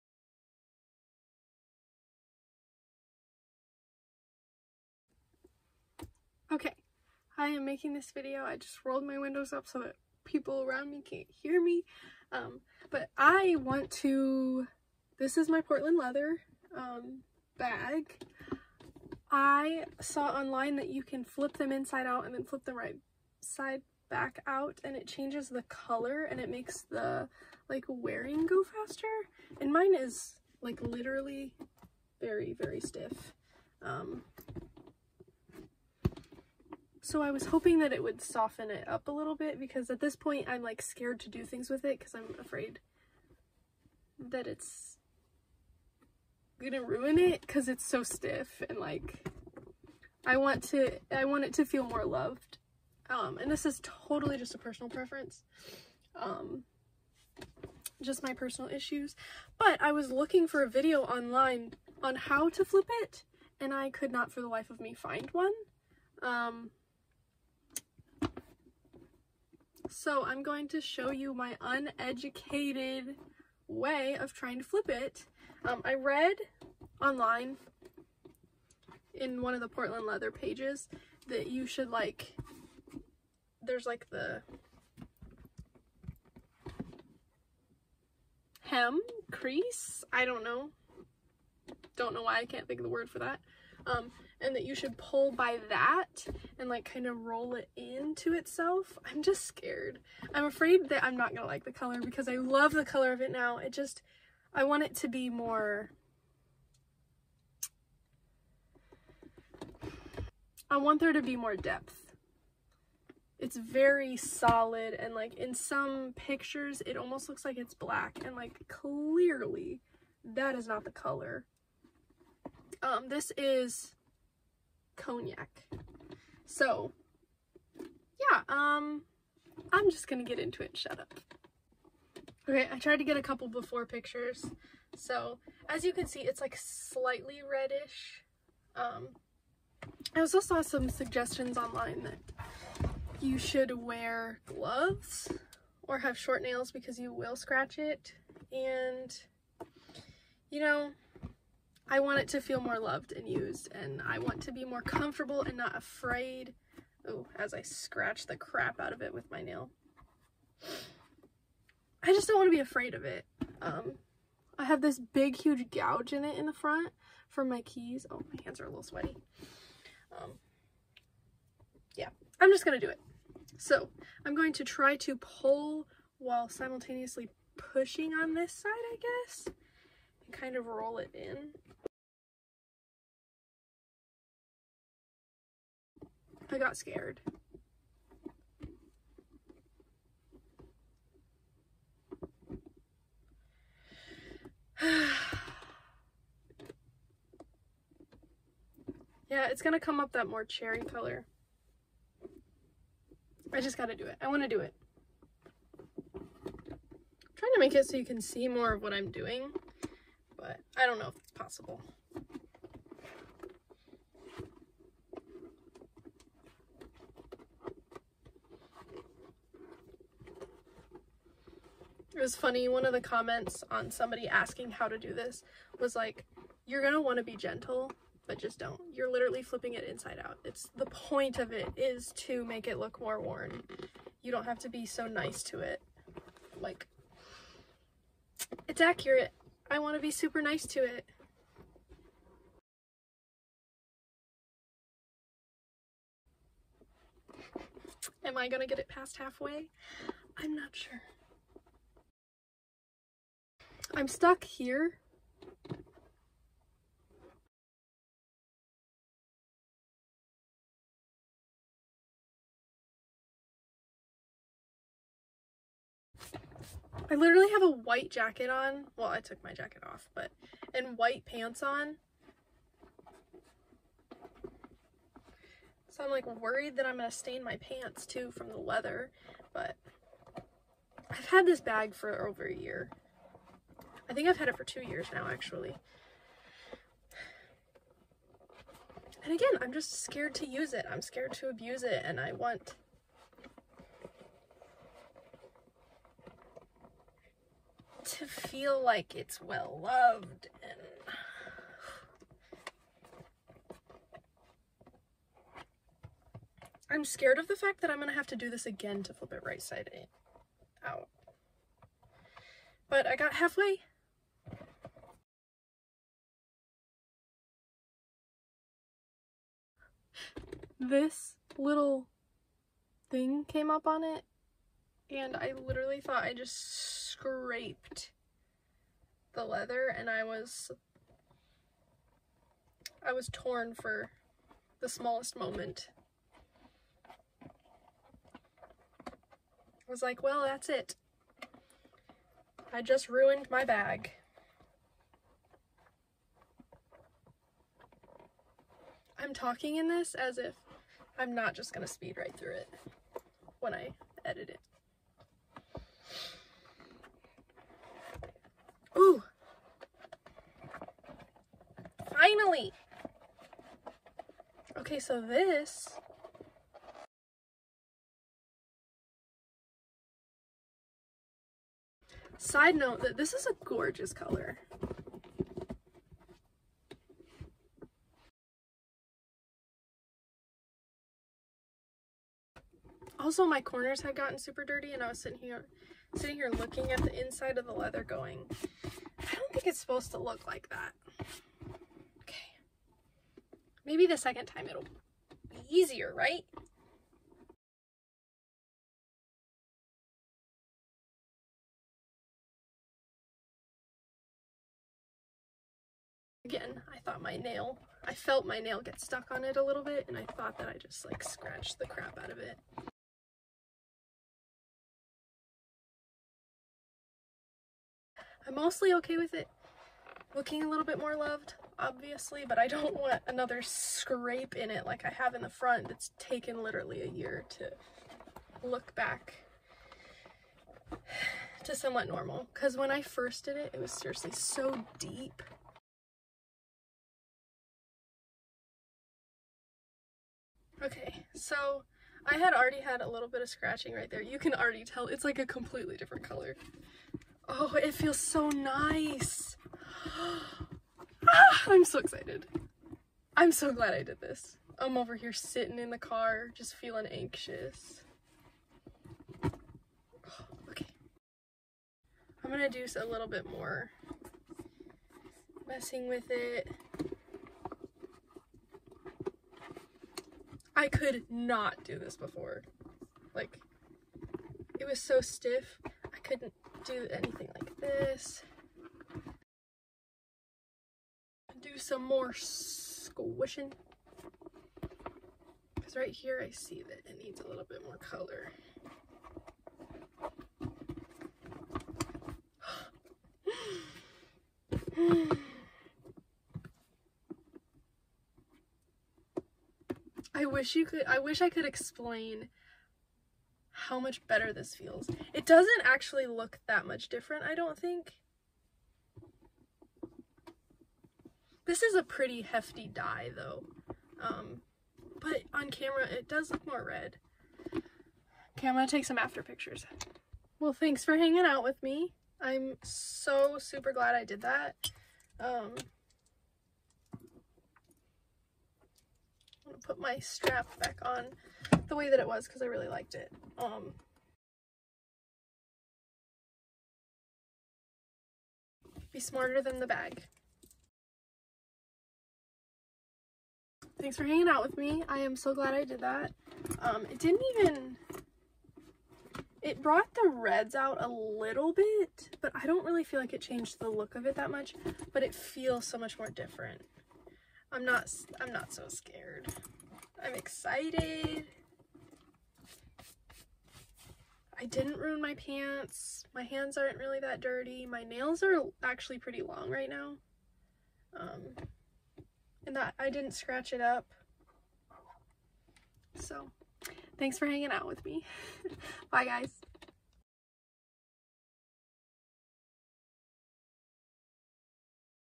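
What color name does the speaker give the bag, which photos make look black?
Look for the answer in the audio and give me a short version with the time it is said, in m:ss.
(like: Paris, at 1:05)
Cognac, at 2:04.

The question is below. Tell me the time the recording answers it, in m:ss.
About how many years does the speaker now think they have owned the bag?
4:44.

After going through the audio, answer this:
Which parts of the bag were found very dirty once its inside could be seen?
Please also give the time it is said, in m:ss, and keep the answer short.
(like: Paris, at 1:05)
Corners, at 6:23.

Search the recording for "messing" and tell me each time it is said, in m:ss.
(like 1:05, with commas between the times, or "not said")
7:45.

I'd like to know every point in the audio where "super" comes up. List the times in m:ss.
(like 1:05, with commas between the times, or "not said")
4:00, 6:24, 8:43.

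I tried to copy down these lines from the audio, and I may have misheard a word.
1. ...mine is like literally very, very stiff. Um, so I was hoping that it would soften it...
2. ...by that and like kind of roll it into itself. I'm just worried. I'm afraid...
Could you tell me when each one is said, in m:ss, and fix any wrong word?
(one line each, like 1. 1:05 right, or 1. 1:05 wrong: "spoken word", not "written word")
1. 0:29 right
2. 1:35 wrong: "scared", not "worried".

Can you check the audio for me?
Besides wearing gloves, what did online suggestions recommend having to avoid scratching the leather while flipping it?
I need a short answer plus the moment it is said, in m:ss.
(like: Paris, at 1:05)
Short nails, at 2:26.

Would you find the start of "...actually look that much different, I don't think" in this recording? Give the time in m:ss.
8:25.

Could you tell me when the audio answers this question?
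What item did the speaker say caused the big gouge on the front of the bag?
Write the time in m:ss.
2:47.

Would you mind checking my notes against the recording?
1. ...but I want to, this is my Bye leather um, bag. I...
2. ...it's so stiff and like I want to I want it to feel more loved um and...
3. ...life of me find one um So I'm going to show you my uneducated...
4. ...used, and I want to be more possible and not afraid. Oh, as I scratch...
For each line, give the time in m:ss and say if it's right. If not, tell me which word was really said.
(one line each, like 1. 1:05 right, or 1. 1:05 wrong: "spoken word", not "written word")
1. 0:12 wrong: "Portland", not "Bye"
2. 0:47 right
3. 1:04 right
4. 2:33 wrong: "comfortable", not "possible".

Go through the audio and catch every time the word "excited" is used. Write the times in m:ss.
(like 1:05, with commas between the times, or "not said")
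7:31, 9:20.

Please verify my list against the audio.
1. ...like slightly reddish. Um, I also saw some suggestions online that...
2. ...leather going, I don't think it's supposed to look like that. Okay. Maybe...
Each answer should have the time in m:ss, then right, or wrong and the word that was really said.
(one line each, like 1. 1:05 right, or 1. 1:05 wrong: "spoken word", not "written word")
1. 2:16 right
2. 6:27 right.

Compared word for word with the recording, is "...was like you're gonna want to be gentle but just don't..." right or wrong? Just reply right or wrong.
right.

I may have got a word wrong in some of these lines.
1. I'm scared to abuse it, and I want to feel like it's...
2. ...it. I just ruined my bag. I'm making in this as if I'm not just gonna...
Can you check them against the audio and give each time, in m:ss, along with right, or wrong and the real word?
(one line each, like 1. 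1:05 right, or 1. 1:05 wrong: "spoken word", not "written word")
1. 4:50 right
2. 5:40 wrong: "talking", not "making".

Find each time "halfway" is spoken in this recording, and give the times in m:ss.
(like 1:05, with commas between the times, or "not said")
4:09, 5:13.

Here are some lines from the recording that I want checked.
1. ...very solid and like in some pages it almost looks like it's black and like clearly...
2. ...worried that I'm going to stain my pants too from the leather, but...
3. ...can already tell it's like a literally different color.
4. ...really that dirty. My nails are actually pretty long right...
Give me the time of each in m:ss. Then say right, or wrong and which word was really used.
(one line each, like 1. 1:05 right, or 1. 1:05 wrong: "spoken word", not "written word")
1. 1:53 wrong: "pictures", not "pages"
2. 4:36 right
3. 7:24 wrong: "completely", not "literally"
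4. 9:26 right.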